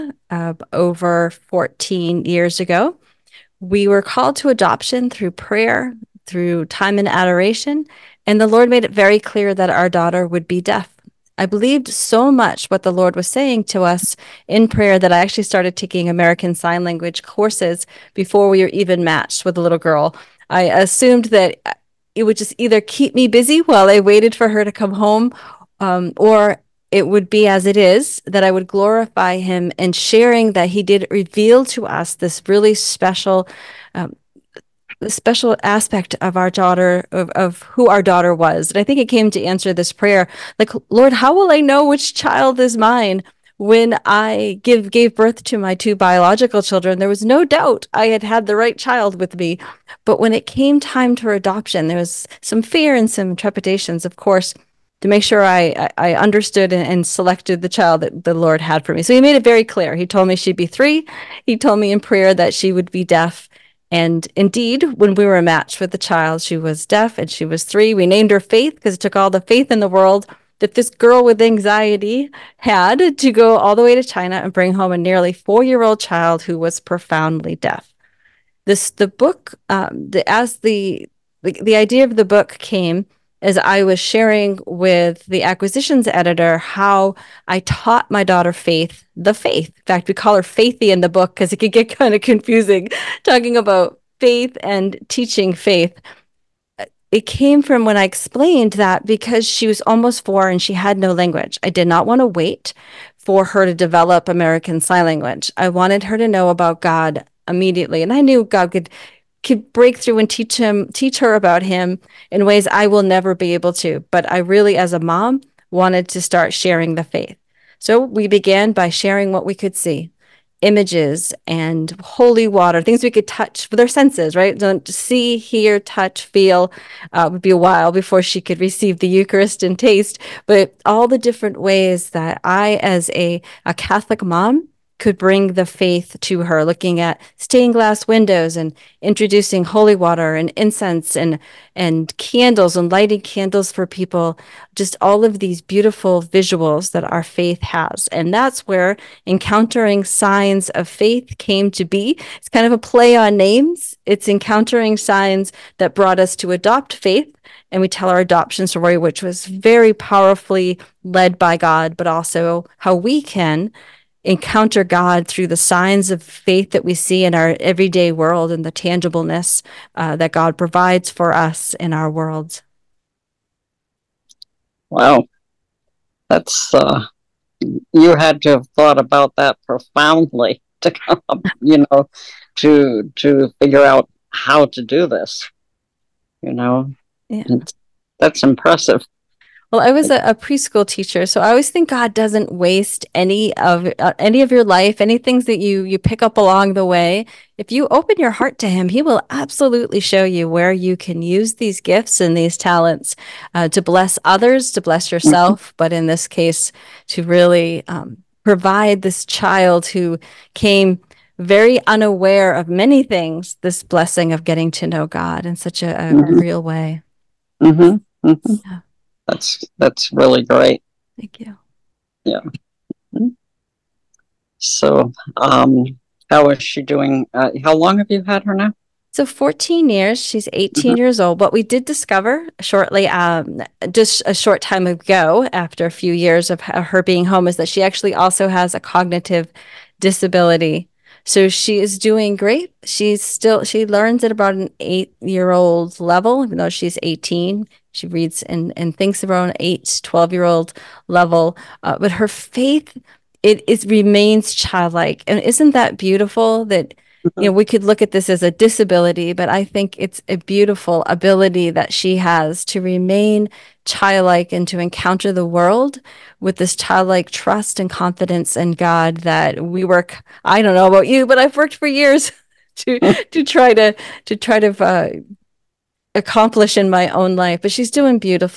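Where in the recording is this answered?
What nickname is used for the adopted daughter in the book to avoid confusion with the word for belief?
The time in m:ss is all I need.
1:30.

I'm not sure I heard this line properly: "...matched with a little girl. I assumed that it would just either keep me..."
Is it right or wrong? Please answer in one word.
right.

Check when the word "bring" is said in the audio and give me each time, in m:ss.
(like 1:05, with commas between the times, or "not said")
1:14, 2:15.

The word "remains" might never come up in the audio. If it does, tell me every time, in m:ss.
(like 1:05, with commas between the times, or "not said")
4:13, 4:22.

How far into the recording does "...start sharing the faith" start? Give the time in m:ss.
1:56.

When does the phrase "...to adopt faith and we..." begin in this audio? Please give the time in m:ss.
2:36.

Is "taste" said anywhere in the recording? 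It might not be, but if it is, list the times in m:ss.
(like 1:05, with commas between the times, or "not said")
2:09.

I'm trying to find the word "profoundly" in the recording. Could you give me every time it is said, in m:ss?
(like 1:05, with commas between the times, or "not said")
1:16, 2:59.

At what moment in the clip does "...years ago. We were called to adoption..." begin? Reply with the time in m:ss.
0:02.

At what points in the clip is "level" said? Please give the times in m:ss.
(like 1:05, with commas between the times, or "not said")
4:06, 4:11.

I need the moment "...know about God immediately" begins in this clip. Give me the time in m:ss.
1:46.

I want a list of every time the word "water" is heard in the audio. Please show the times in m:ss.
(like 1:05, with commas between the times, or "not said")
2:02, 2:19.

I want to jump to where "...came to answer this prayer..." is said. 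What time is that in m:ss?
0:39.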